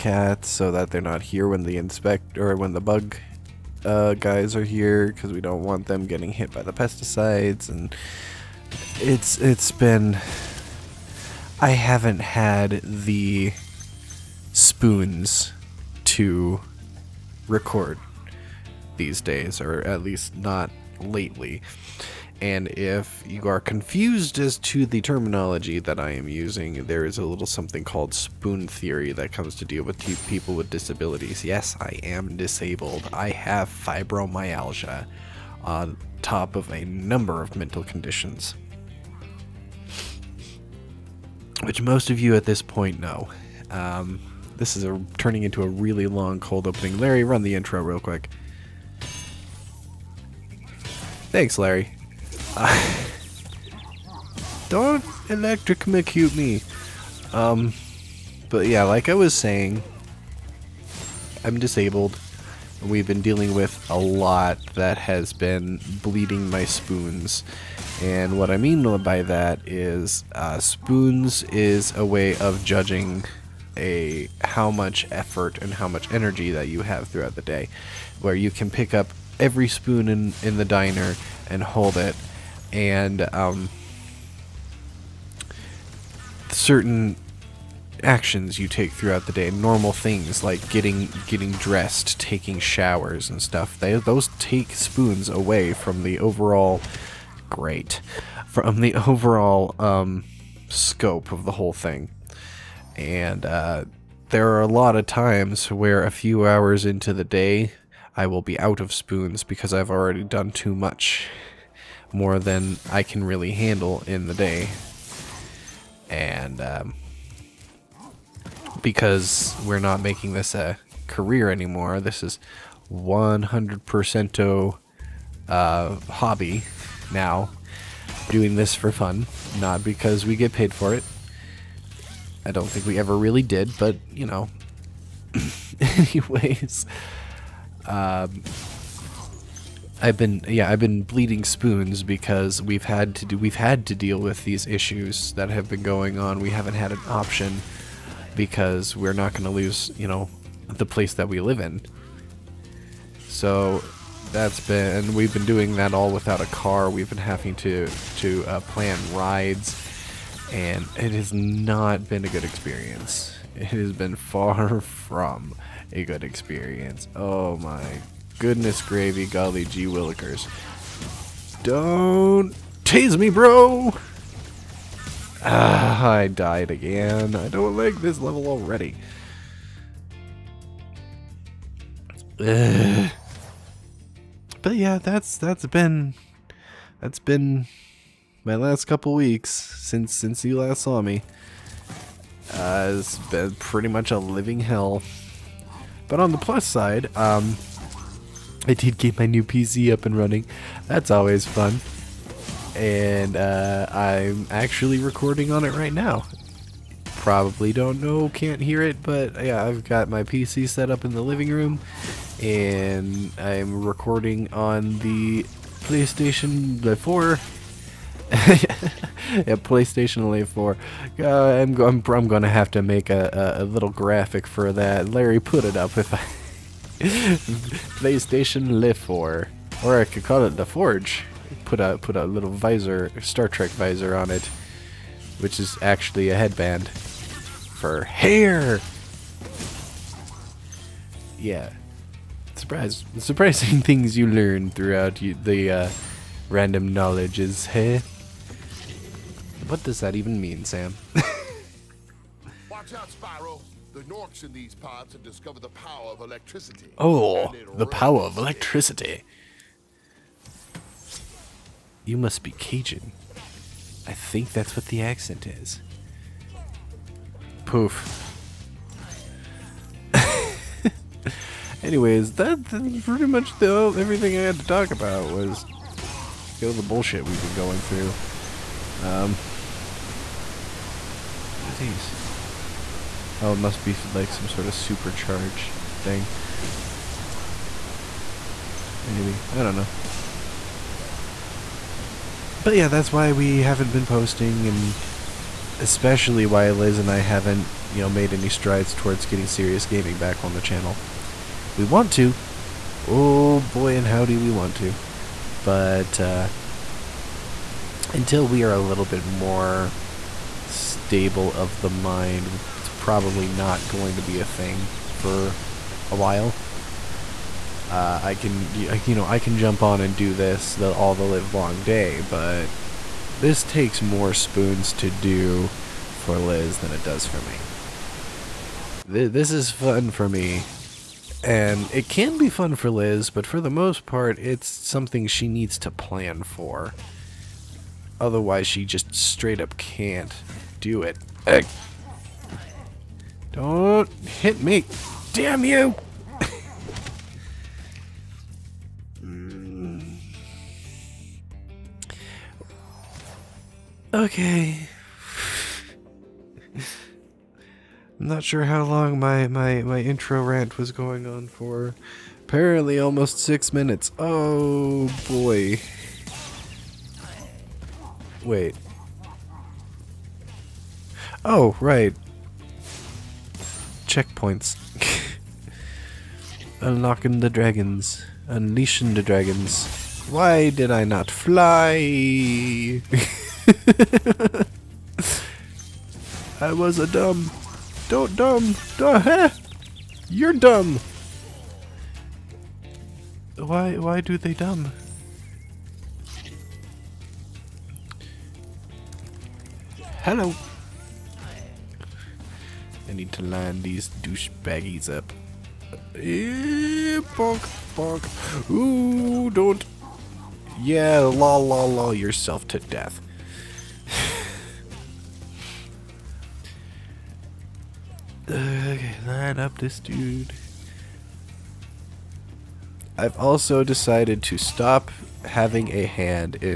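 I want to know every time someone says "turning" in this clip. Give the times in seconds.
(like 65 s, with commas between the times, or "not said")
45 s.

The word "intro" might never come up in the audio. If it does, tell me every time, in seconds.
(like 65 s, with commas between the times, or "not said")
47 s, 360 s.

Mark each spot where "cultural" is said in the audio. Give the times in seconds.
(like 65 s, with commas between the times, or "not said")
not said.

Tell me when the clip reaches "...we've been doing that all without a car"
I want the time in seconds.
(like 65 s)
155 s.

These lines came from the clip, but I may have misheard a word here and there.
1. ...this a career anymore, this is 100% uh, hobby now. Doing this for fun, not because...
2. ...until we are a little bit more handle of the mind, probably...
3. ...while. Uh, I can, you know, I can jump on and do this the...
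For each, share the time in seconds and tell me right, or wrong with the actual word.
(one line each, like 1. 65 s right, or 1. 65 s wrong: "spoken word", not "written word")
1. 120 s right
2. 308 s wrong: "stable", not "handle"
3. 316 s right.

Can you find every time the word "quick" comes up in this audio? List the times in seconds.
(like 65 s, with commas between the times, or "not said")
47 s.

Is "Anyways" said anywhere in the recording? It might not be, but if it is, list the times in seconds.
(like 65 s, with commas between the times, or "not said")
135 s, 271 s.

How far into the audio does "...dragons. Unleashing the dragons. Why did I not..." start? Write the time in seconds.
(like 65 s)
377 s.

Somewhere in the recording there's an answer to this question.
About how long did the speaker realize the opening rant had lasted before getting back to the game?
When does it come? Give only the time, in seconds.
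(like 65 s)
362 s.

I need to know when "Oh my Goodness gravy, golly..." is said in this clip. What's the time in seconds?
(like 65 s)
167 s.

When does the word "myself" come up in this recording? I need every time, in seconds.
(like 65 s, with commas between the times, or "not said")
not said.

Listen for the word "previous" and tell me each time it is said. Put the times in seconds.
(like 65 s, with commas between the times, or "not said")
not said.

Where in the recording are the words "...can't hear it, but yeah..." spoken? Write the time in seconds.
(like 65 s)
208 s.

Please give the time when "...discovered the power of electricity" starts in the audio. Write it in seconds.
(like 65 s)
255 s.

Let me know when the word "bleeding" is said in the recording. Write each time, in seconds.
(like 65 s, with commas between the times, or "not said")
66 s, 141 s.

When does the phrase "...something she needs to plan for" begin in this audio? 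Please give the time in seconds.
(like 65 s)
334 s.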